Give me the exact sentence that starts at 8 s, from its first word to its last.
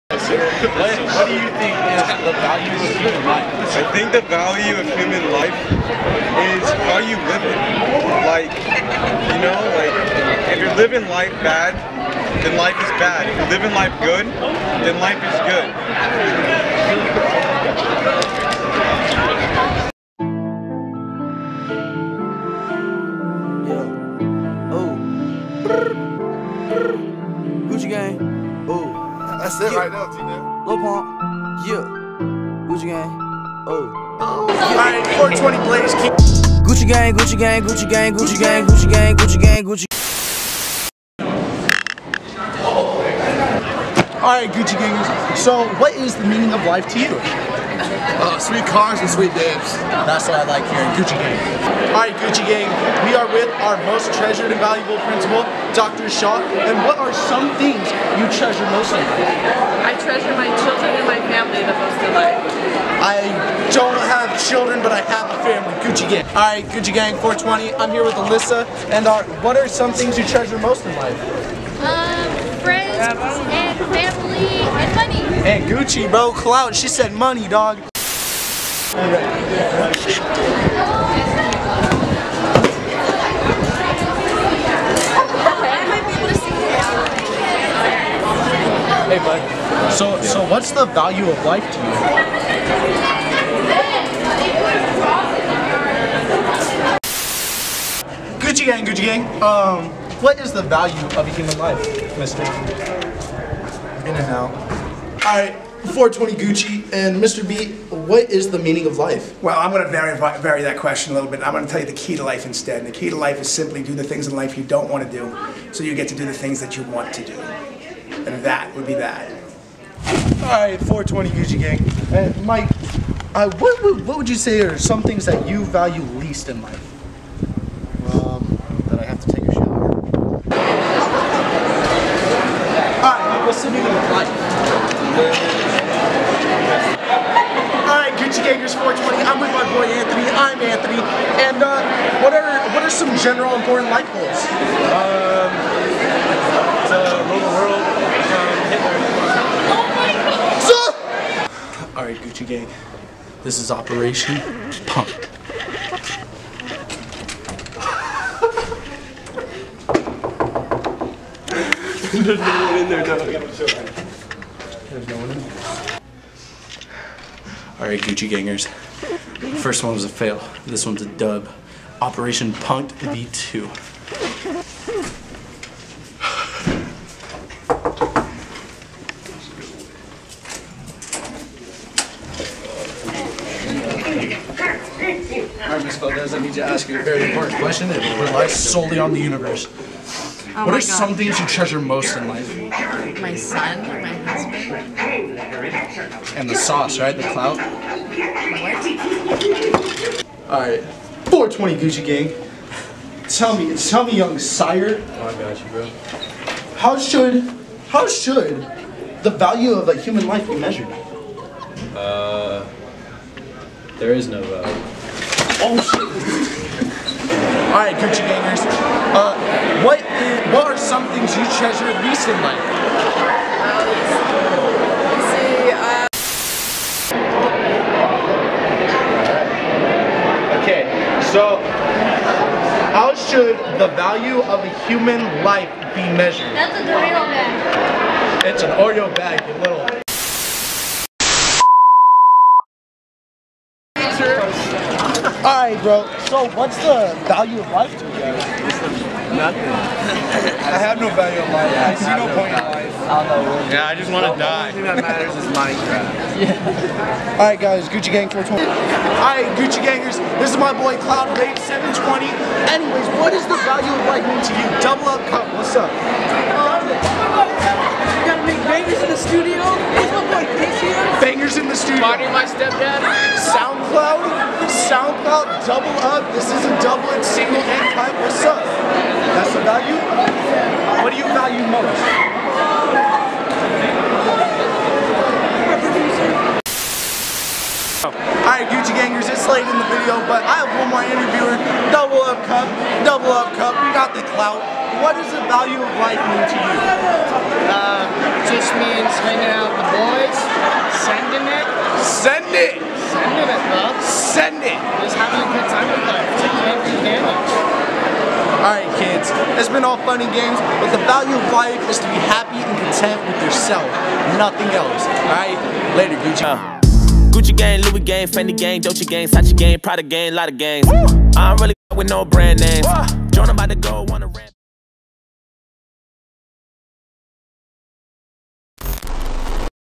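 Like, you know, like, if you're living life bad, then life is bad.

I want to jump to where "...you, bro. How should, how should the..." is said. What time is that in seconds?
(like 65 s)
205 s.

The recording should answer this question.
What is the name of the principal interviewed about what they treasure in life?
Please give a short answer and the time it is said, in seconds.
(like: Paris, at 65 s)
Dr. Shaw, at 55 s.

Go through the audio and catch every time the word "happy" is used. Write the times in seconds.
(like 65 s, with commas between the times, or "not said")
312 s.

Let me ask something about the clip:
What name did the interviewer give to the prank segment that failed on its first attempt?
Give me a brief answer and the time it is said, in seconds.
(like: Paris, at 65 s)
Operation Punk, at 153 s.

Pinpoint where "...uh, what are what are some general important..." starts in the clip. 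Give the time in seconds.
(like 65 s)
141 s.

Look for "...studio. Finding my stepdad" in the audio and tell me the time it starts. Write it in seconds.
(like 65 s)
271 s.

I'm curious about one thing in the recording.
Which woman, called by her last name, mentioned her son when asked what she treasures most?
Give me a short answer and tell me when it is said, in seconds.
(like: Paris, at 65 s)
Miss Valdez, at 185 s.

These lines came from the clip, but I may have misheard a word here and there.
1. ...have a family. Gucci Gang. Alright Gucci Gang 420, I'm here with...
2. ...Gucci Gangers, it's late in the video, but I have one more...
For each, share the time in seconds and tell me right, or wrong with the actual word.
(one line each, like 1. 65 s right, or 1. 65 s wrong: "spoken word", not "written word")
1. 65 s right
2. 288 s right.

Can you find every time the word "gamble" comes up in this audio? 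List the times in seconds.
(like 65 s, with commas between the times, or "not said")
not said.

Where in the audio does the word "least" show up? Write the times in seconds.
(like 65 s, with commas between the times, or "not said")
126 s, 222 s.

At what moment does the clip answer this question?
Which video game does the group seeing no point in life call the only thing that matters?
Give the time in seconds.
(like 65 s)
255 s.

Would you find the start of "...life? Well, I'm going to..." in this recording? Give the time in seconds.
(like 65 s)
108 s.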